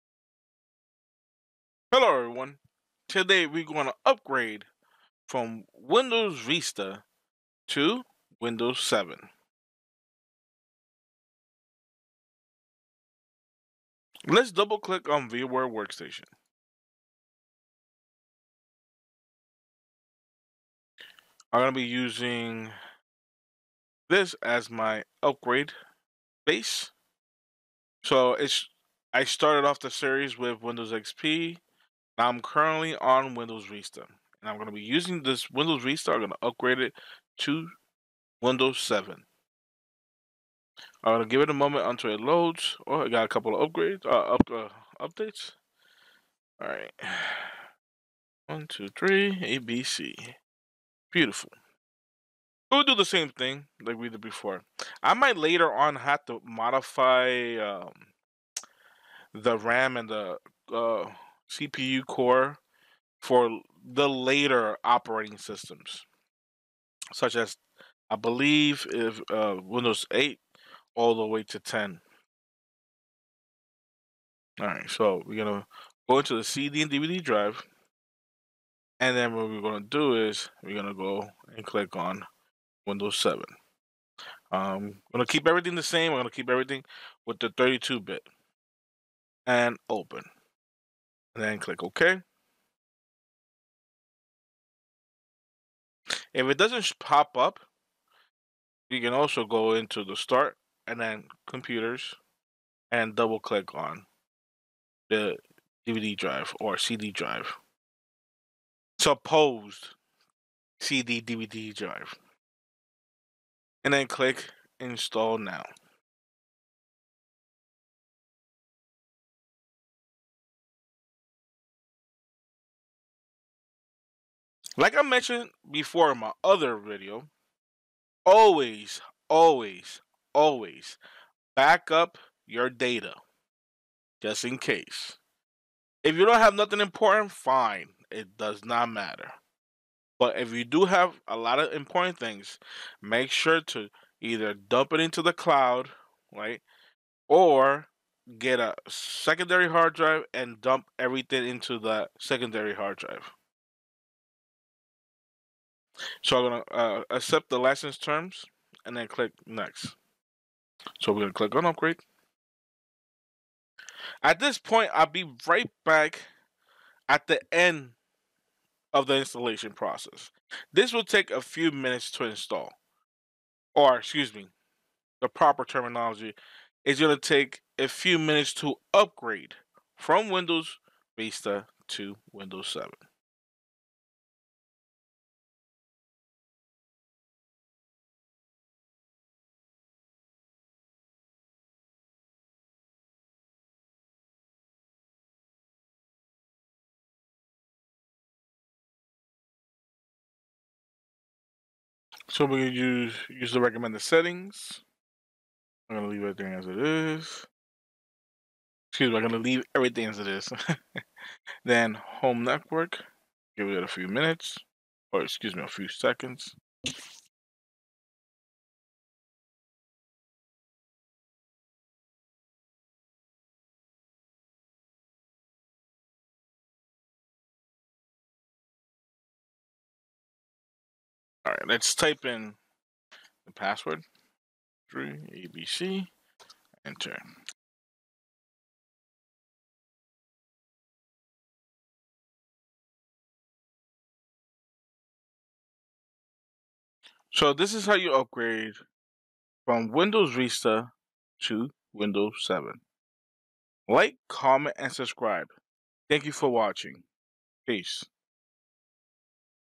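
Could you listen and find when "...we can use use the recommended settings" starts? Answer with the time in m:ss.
3:22.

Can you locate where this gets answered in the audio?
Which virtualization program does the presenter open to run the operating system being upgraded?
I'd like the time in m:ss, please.
0:15.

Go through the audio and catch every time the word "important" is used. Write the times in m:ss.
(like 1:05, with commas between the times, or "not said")
2:16, 2:21.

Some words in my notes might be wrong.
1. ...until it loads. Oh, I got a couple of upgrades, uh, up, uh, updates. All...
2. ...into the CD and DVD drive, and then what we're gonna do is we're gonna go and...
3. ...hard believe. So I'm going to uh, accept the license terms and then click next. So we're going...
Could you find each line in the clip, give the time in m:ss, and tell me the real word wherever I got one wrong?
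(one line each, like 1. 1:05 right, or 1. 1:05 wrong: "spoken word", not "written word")
1. 0:41 right
2. 1:16 right
3. 2:32 wrong: "drive", not "believe".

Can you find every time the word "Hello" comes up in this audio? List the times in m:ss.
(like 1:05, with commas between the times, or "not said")
0:01.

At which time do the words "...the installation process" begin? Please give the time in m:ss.
2:49.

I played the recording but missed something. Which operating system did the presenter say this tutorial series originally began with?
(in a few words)
Windows XP.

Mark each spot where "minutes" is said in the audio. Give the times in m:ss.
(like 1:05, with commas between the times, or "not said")
2:51, 2:58, 3:34.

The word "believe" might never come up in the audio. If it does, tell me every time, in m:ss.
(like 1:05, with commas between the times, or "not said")
1:08.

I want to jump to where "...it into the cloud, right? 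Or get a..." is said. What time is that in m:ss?
2:24.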